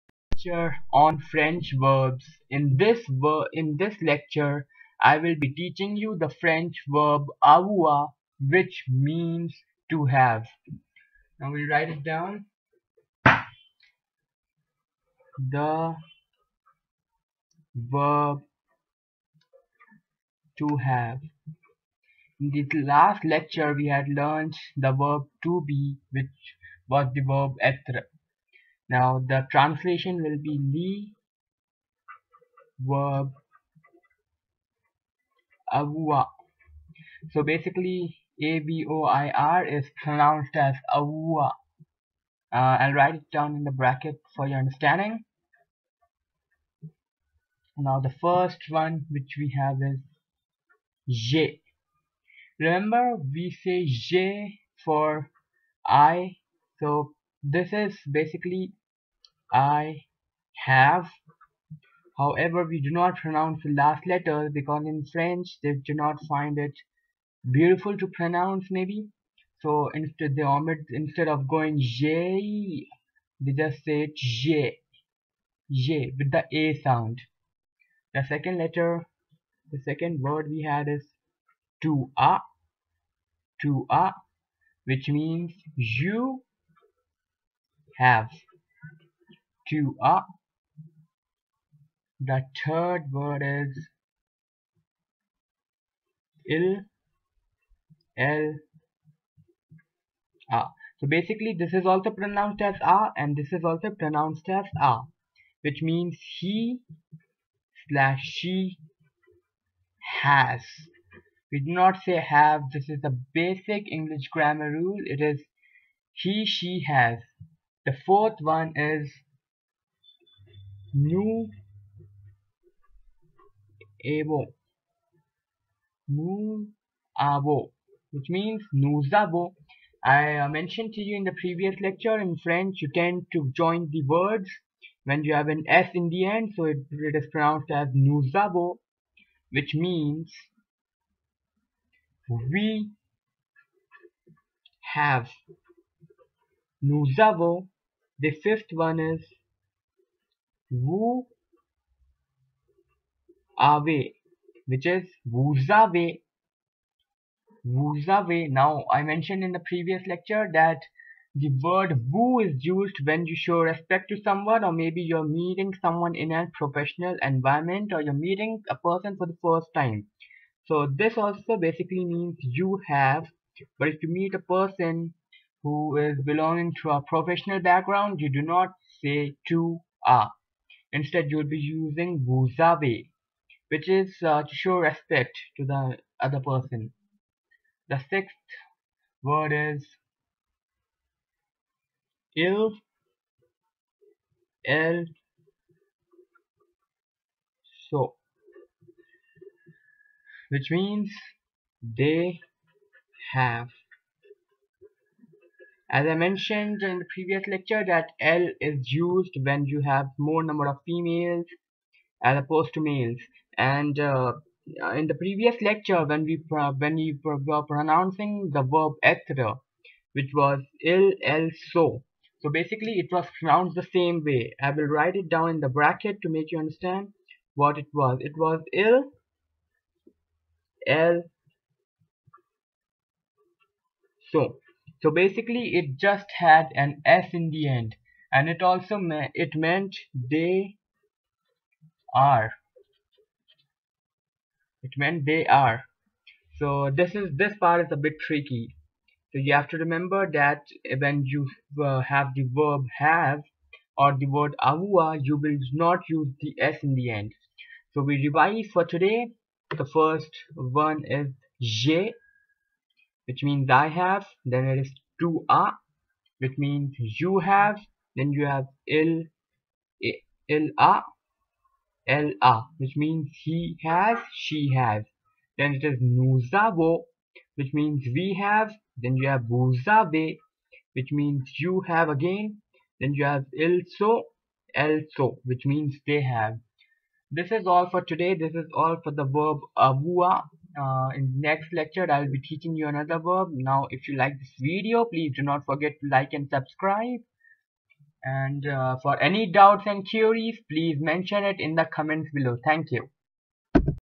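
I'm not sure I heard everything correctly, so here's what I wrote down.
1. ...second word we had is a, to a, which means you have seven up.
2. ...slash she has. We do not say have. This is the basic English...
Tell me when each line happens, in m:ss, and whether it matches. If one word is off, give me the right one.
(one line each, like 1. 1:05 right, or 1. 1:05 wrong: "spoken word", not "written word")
1. 1:19 wrong: "two", not "seven"
2. 1:47 right.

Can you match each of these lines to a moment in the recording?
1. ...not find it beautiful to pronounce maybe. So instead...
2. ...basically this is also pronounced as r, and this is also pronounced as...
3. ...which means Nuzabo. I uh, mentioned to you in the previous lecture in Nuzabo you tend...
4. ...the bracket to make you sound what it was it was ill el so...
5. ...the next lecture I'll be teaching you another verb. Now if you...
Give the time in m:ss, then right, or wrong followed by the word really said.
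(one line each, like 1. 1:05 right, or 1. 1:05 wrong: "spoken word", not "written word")
1. 1:05 right
2. 1:41 right
3. 2:08 wrong: "French", not "Nuzabo"
4. 3:45 wrong: "understand", not "sound"
5. 4:51 right.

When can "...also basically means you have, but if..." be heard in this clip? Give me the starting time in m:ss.
2:51.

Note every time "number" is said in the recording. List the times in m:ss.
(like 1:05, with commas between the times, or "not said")
3:30.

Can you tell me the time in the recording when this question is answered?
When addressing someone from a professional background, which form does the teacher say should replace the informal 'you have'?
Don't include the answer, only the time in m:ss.
3:02.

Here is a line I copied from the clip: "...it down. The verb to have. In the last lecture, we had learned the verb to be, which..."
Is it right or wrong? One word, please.
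right.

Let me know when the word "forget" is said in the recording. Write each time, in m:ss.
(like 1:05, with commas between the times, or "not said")
4:55.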